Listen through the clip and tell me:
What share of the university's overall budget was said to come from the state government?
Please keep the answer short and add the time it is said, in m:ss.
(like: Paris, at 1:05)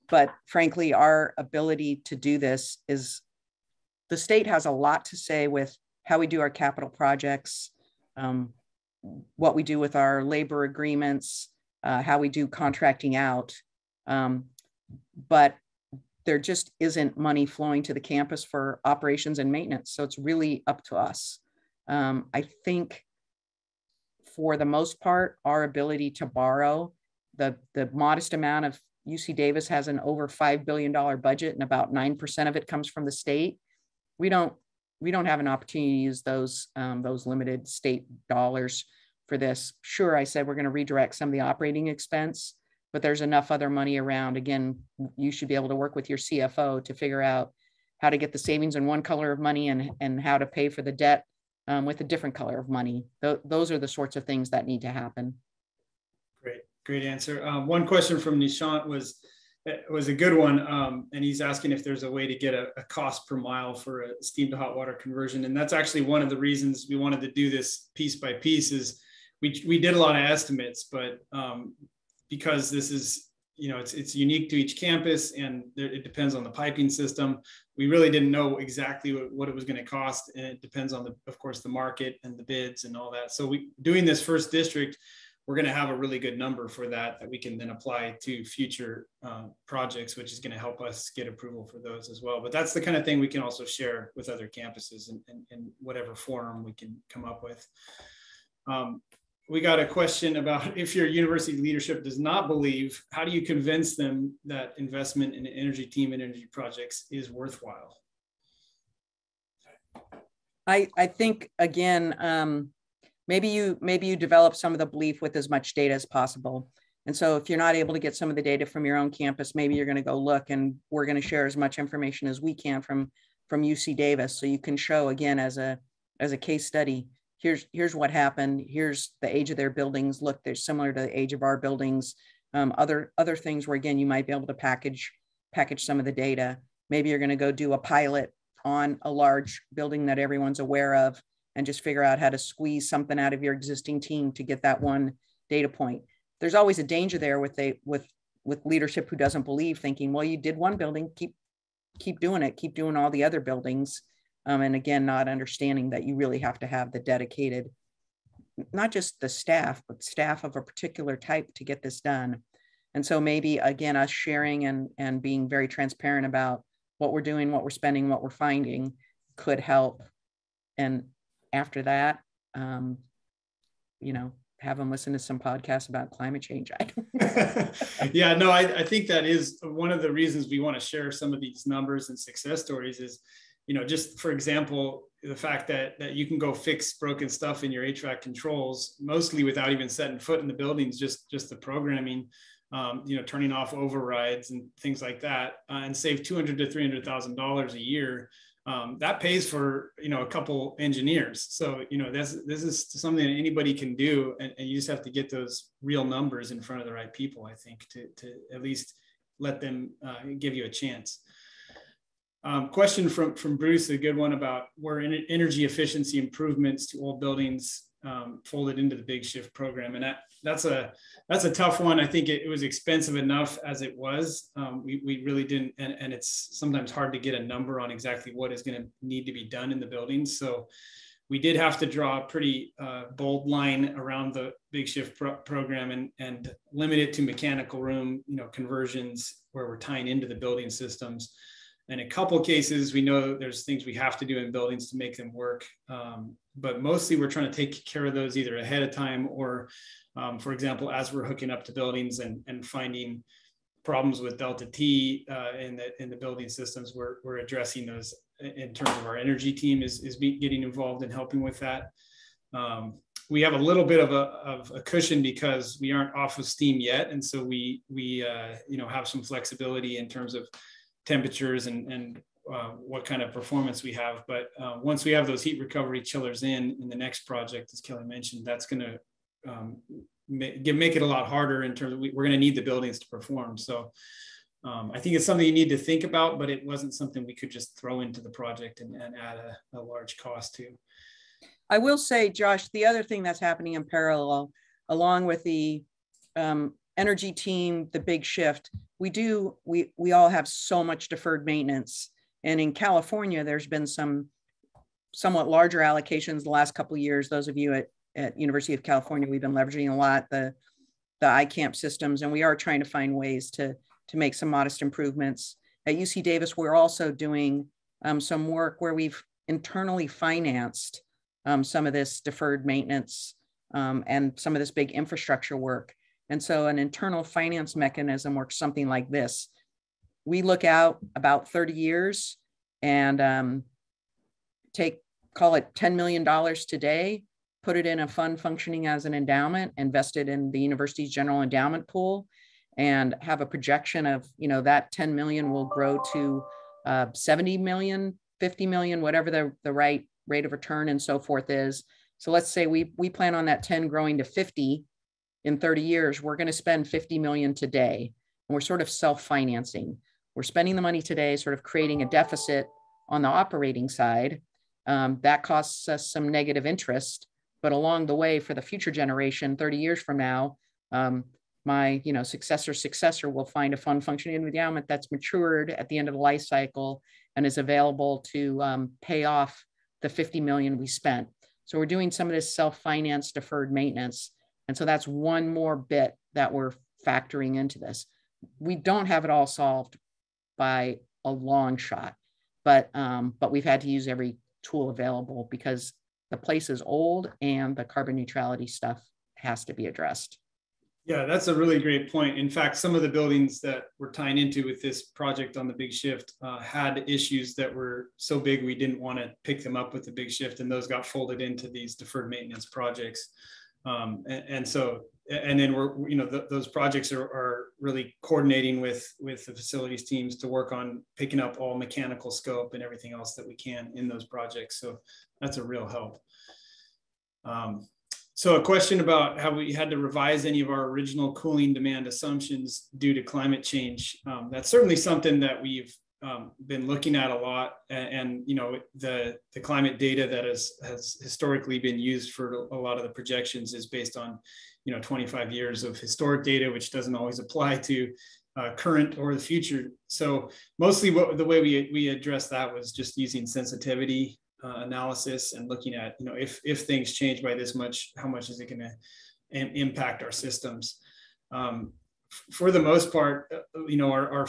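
9%, at 0:31.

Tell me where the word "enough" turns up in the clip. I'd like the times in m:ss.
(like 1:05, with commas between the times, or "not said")
0:43, 3:43.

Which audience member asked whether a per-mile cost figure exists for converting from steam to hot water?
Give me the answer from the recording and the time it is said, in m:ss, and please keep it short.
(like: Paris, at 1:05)
Nishant, at 0:58.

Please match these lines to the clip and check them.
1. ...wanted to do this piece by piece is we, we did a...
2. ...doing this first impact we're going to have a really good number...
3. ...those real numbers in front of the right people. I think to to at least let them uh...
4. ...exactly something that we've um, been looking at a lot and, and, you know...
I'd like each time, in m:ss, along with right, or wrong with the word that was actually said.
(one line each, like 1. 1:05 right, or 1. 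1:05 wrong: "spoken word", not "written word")
1. 1:06 right
2. 1:23 wrong: "district", not "impact"
3. 3:25 right
4. 7:14 wrong: "certainly", not "exactly".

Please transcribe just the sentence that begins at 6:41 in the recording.
Yeah, that's a really great point.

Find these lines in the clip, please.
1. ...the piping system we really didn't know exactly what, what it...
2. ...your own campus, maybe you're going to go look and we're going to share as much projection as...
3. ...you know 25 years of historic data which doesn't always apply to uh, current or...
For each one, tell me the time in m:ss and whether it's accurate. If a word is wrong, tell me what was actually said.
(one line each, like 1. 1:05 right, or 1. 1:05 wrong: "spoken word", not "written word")
1. 1:16 right
2. 1:58 wrong: "information", not "projection"
3. 7:24 right.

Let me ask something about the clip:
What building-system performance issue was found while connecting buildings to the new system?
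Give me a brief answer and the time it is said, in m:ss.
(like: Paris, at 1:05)
Delta T, at 4:14.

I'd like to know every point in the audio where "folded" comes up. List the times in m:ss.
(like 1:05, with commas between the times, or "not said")
3:38, 6:51.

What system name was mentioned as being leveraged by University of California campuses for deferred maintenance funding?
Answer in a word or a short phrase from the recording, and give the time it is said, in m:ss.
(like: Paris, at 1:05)
iCamp, at 5:11.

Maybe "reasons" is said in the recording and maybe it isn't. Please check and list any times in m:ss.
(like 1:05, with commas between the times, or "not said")
1:06, 3:00.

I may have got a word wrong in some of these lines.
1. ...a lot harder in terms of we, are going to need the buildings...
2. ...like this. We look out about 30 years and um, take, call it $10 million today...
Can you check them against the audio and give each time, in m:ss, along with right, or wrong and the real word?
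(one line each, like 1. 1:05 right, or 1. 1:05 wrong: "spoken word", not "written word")
1. 4:41 right
2. 5:28 right.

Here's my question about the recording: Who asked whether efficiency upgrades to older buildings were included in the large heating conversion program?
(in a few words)
Bruce.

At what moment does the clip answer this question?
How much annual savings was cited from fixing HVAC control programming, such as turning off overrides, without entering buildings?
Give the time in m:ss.
3:16.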